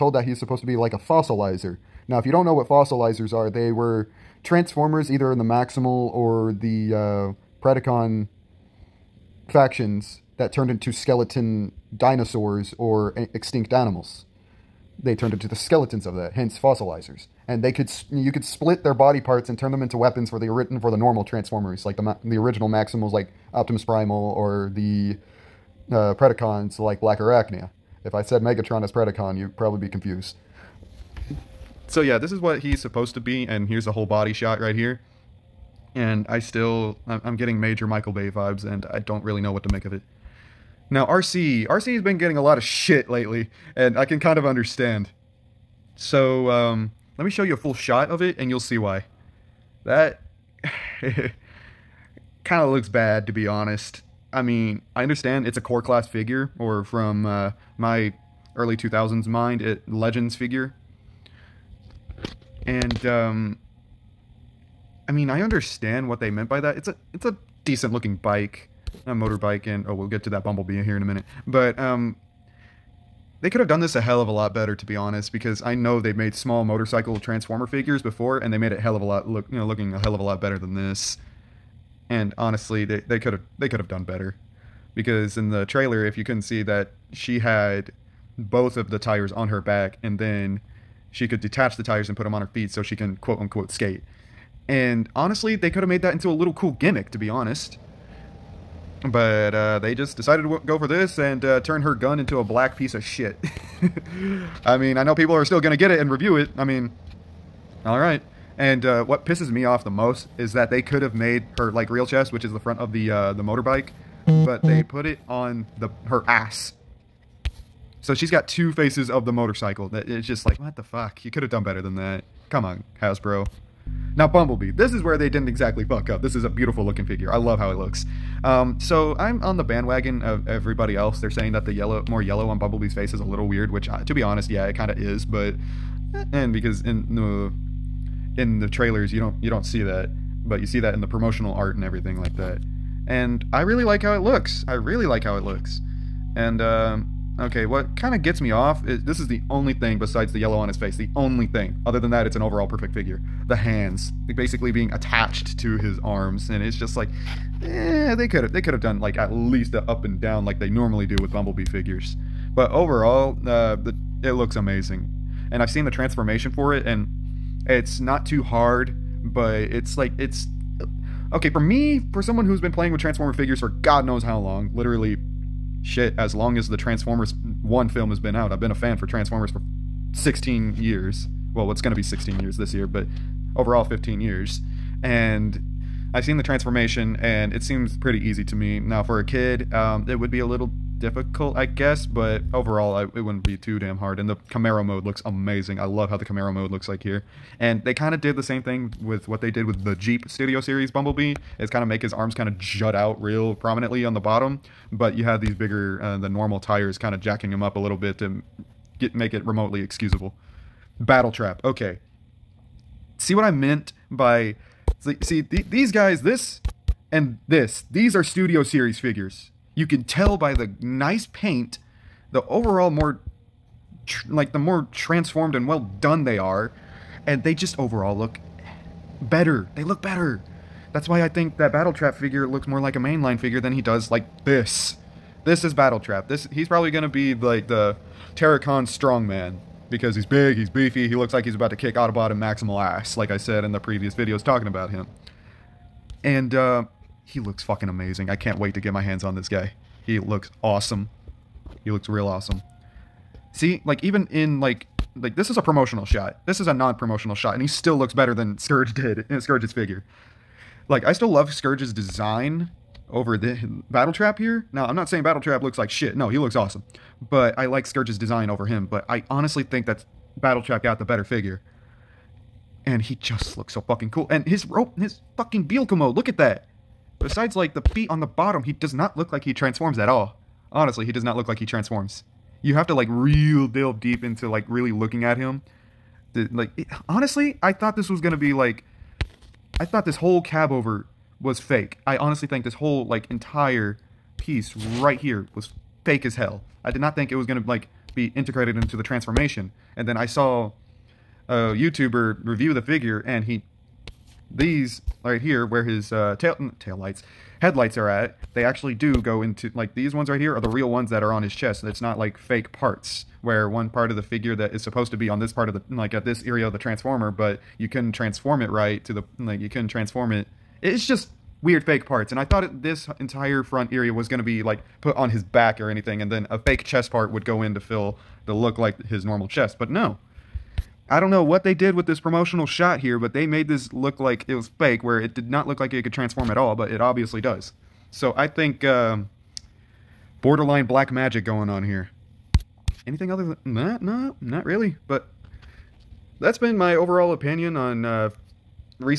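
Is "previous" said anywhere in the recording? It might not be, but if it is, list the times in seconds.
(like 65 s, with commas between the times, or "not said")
243 s.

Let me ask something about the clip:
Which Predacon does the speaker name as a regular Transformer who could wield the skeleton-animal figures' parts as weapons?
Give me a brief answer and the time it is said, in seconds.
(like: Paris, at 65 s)
Black Arachnia, at 26 s.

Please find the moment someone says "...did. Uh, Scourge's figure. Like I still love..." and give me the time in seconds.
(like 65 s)
258 s.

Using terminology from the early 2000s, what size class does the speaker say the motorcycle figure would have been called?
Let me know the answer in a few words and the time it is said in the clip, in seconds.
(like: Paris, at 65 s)
Legends, at 59 s.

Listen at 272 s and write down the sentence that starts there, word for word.
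And he just looks so fucking cool.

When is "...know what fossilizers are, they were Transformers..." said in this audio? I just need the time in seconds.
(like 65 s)
2 s.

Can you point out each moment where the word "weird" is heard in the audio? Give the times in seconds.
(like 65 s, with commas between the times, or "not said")
133 s, 321 s.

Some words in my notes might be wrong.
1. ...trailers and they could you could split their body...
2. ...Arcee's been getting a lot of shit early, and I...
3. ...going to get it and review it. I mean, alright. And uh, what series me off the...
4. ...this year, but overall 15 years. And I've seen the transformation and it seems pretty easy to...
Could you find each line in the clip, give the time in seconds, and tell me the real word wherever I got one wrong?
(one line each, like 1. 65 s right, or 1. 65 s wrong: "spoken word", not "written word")
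1. 16 s wrong: "fossilizers", not "trailers"
2. 41 s wrong: "lately", not "early"
3. 105 s wrong: "pisses", not "series"
4. 182 s right.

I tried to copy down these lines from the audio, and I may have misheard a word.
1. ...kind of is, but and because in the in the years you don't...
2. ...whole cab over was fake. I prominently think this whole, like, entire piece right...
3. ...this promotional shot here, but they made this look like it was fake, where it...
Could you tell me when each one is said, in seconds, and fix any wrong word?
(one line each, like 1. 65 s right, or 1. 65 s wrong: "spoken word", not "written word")
1. 134 s wrong: "trailers", not "years"
2. 290 s wrong: "honestly", not "prominently"
3. 332 s right.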